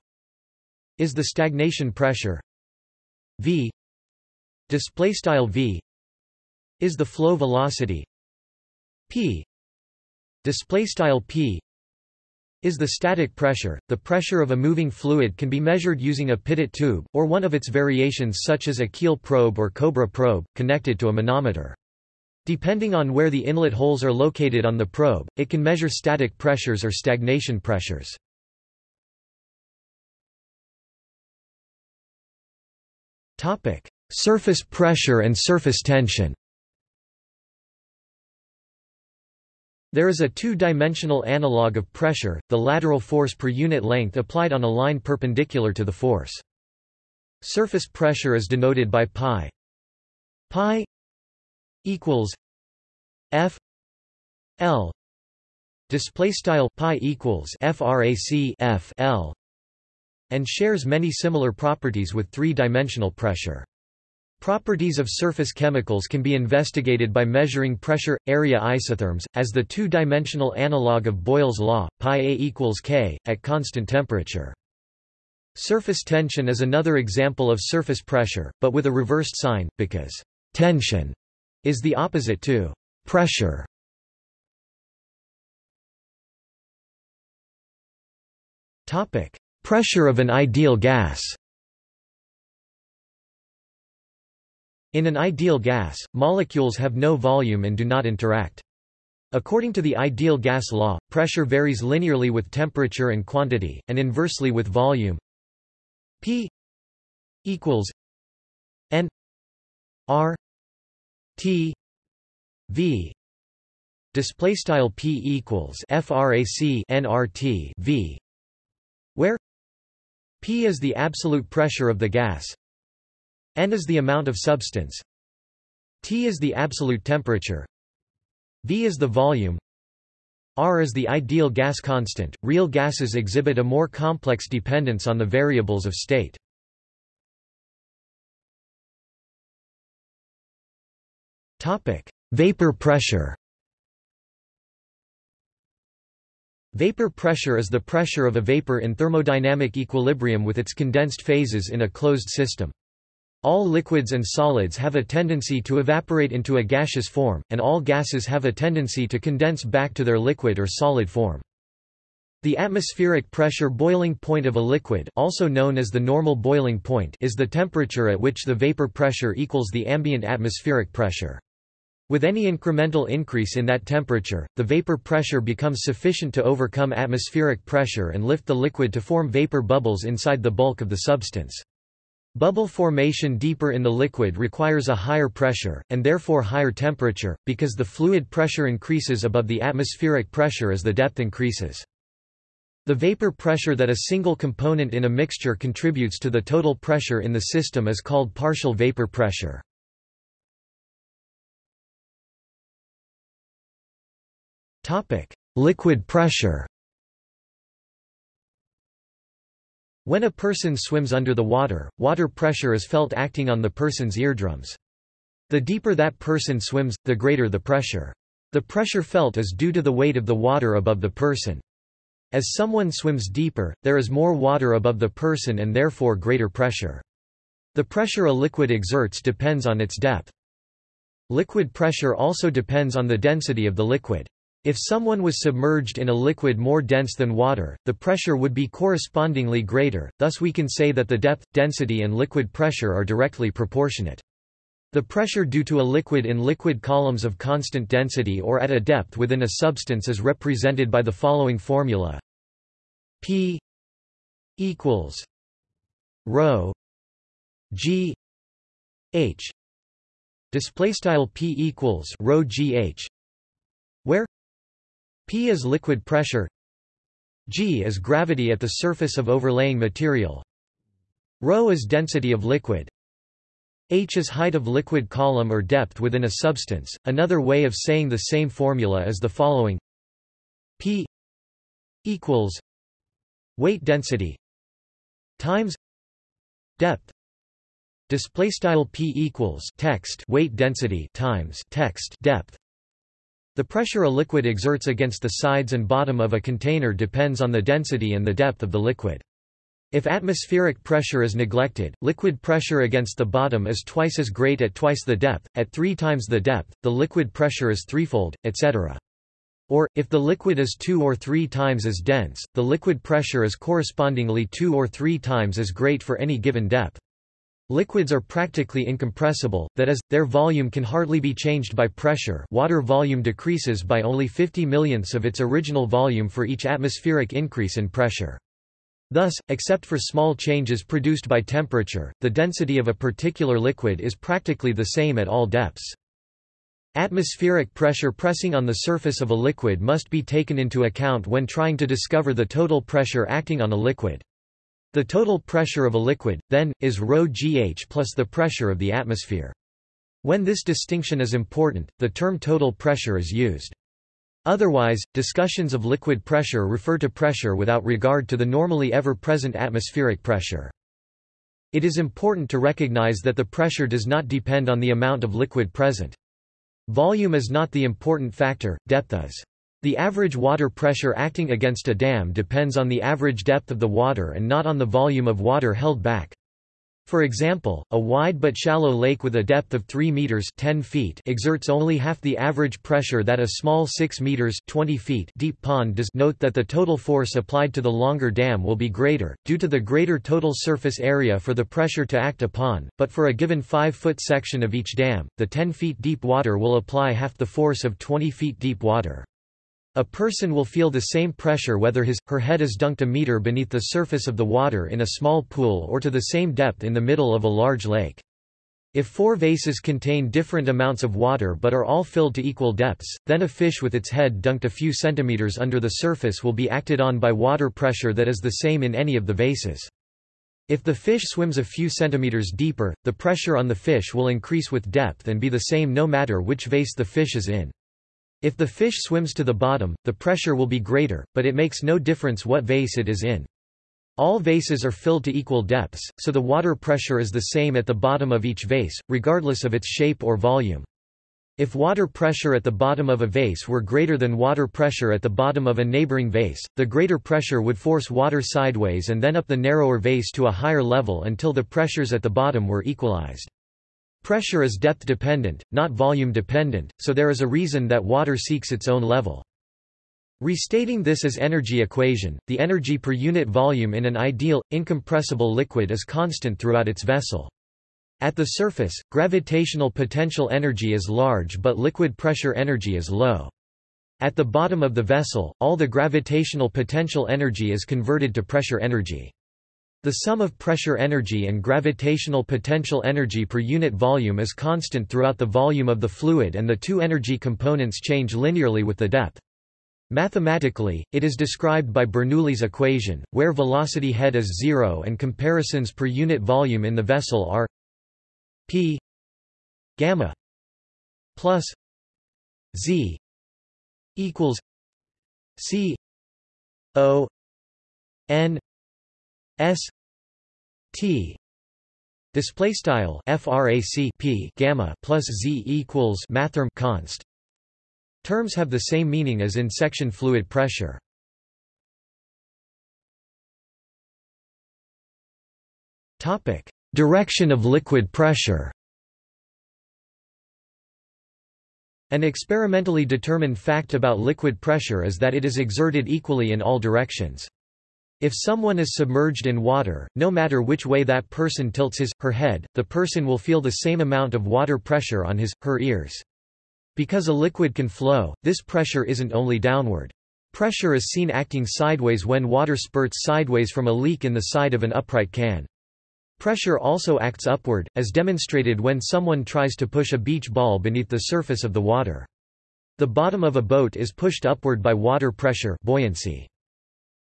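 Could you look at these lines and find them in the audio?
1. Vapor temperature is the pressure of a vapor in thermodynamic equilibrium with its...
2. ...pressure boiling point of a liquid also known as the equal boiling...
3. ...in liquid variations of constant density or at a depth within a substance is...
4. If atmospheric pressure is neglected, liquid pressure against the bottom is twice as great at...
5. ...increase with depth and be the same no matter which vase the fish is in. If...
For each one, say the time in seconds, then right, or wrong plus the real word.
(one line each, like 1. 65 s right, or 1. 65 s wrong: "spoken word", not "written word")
1. 146 s wrong: "pressure", not "temperature"
2. 163 s wrong: "normal", not "equal"
3. 246 s wrong: "columns", not "variations"
4. 299 s right
5. 424 s right.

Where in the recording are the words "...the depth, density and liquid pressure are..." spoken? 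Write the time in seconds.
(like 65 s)
241 s.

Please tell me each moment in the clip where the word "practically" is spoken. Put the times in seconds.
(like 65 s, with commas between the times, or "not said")
318 s, 334 s.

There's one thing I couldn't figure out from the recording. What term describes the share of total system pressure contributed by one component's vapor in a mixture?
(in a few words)
partial vapor pressure.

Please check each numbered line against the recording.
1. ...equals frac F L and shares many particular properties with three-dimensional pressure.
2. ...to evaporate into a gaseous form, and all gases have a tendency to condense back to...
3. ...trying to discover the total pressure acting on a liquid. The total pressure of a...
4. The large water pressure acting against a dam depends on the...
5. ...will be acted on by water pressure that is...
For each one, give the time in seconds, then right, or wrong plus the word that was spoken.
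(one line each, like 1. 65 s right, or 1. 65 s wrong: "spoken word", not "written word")
1. 56 s wrong: "similar", not "particular"
2. 155 s right
3. 341 s right
4. 369 s wrong: "average", not "large"
5. 416 s right.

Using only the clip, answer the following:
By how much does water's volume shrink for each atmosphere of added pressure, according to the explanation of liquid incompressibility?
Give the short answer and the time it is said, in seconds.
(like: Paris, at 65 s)
50 millionths, at 324 s.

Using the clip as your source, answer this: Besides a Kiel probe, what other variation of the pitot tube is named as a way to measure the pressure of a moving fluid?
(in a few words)
cobra probe.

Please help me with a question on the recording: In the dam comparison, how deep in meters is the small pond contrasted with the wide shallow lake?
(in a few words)
6 meters.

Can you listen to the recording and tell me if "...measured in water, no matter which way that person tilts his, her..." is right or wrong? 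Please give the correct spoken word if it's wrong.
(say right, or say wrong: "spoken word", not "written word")
wrong: "submerged", not "measured".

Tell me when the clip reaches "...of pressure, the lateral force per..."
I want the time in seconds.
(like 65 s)
41 s.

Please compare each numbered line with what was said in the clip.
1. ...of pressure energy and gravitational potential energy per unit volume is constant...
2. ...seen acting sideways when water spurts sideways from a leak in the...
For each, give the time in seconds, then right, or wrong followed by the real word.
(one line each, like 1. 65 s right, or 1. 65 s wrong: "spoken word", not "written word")
1. 480 s right
2. 551 s right.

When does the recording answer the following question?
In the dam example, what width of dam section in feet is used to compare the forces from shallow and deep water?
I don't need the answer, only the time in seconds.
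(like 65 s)
393 s.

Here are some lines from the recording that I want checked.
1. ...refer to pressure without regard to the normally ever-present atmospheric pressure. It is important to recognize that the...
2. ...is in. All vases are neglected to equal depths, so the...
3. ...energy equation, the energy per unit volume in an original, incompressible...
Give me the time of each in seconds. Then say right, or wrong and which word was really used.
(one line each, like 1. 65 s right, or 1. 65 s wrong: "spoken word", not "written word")
1. 356 s right
2. 433 s wrong: "filled", not "neglected"
3. 461 s wrong: "ideal", not "original".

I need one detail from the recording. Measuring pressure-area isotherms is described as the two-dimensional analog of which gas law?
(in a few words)
Boyle's law.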